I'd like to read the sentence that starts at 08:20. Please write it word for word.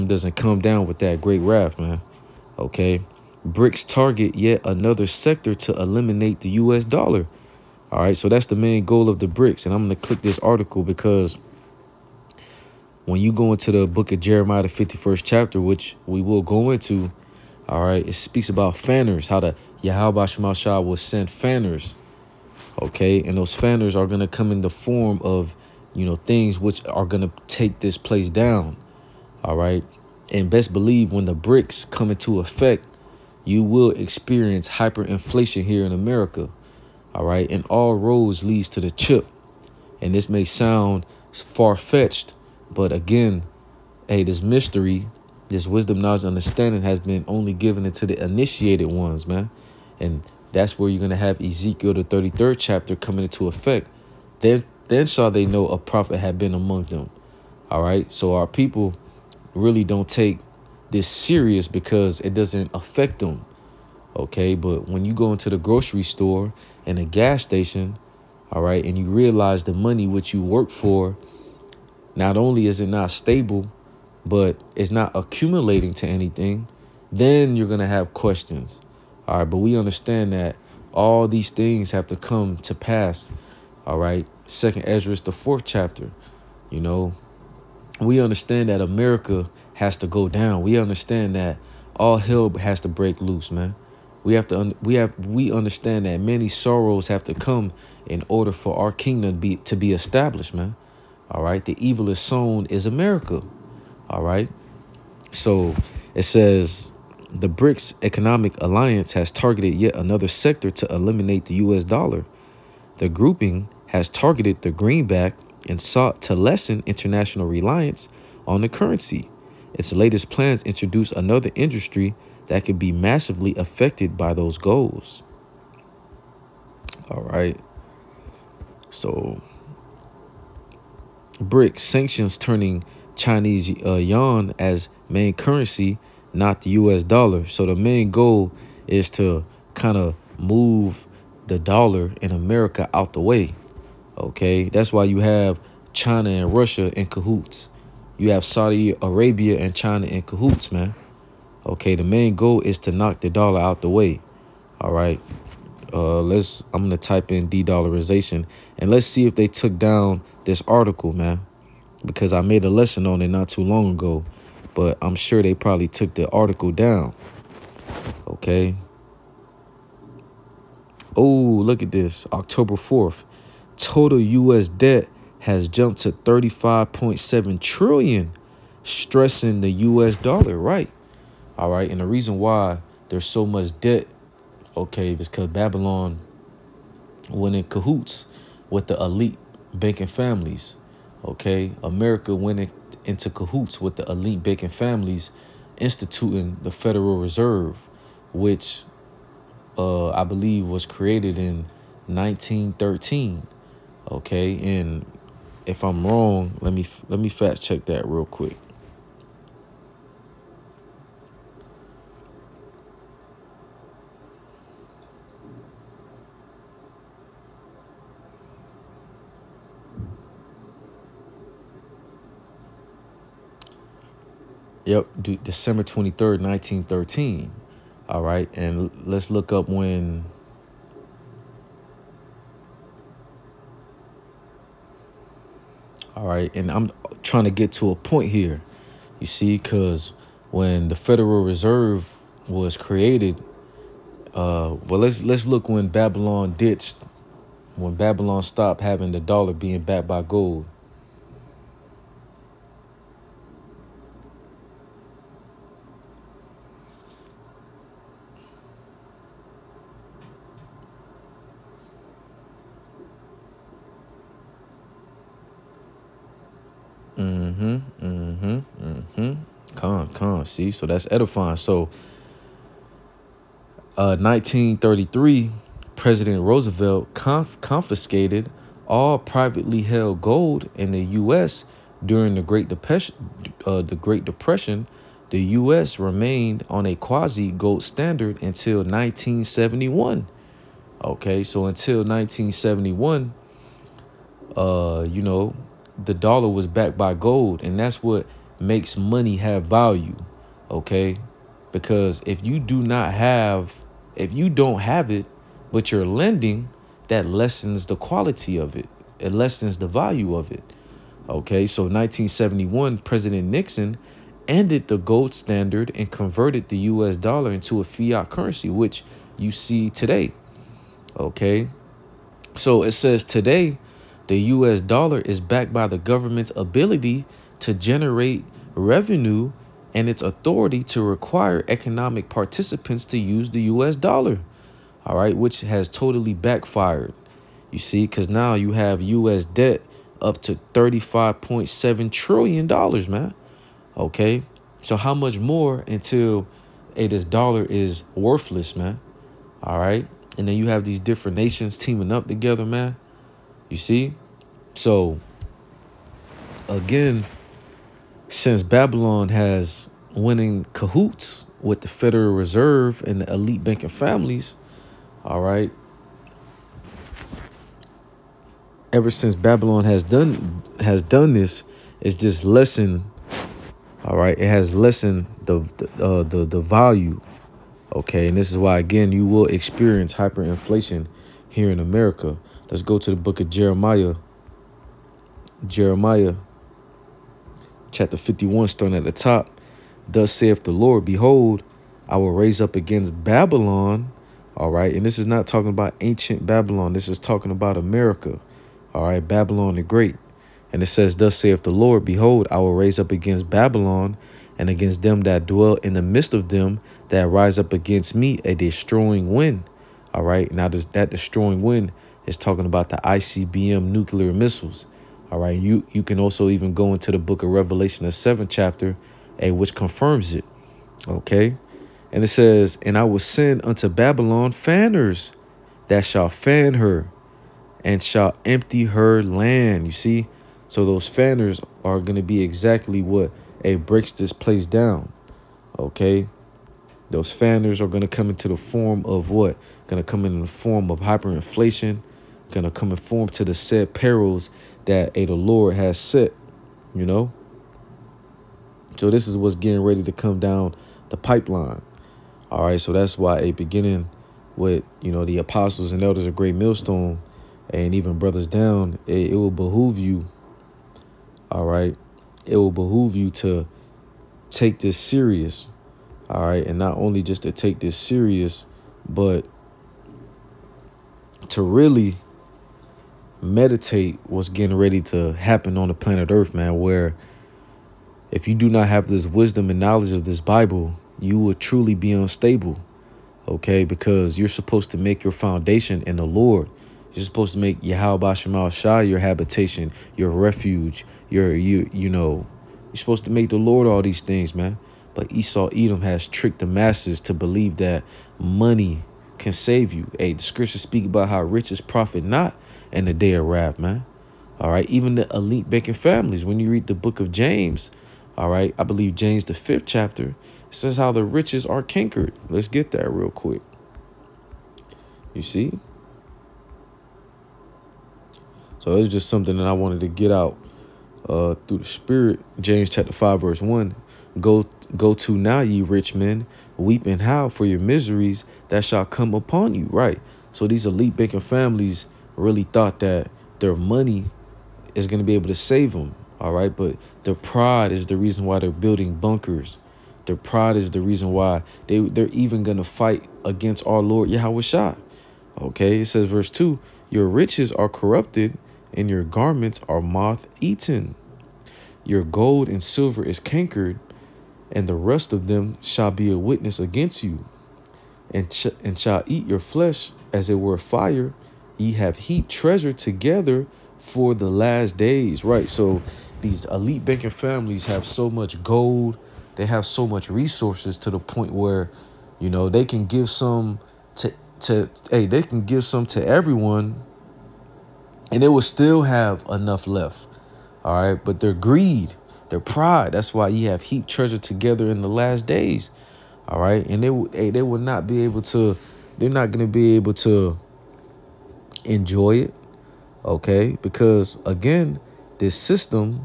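Hey, the scriptures speak about how riches profit not and the day of wrath, man.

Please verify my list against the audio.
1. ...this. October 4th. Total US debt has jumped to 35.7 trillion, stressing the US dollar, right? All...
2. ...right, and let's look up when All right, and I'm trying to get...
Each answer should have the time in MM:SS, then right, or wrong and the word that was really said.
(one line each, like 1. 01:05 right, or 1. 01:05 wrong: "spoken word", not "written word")
1. 02:51 right
2. 03:48 right.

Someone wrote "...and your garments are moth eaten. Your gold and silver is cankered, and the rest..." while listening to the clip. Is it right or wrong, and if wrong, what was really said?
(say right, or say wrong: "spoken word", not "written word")
right.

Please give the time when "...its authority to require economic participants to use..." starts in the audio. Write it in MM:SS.
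05:30.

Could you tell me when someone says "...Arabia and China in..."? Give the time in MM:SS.
02:29.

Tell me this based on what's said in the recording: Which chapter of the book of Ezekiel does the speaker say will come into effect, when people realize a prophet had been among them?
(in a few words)
33rd chapter.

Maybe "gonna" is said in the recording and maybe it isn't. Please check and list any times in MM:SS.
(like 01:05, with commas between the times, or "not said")
02:36, 07:22.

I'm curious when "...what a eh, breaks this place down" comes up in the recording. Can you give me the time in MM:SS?
07:13.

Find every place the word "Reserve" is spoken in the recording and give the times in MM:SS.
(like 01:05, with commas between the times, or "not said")
03:17, 04:01, 06:02.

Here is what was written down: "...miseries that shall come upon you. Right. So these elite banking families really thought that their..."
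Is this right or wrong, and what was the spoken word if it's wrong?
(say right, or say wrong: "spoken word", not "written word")
right.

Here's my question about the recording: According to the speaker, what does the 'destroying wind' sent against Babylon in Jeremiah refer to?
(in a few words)
ICBM nuclear missiles.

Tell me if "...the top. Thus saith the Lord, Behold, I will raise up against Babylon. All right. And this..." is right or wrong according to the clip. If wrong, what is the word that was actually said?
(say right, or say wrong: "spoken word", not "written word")
right.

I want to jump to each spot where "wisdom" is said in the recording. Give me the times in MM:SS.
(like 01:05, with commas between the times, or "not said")
00:45, 07:59.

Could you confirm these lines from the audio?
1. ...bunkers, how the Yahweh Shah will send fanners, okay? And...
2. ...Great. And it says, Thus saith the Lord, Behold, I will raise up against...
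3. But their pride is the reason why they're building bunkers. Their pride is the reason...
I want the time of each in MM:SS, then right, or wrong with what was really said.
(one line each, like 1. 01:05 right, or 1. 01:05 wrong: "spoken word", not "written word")
1. 00:18 wrong: "fanners", not "bunkers"
2. 06:39 right
3. 08:56 right.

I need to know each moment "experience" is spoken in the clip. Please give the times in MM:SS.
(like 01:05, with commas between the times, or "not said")
00:33, 06:19.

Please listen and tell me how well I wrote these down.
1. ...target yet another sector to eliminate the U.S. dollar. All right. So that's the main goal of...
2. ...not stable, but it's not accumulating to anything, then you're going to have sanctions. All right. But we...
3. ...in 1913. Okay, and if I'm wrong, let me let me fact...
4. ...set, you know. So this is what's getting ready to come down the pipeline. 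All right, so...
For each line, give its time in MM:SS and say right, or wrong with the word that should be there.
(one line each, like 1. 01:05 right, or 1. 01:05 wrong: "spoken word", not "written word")
1. 00:03 right
2. 01:12 wrong: "questions", not "sanctions"
3. 03:21 right
4. 07:25 right.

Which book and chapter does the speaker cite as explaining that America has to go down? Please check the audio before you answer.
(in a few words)
Second Ezra chapter 4.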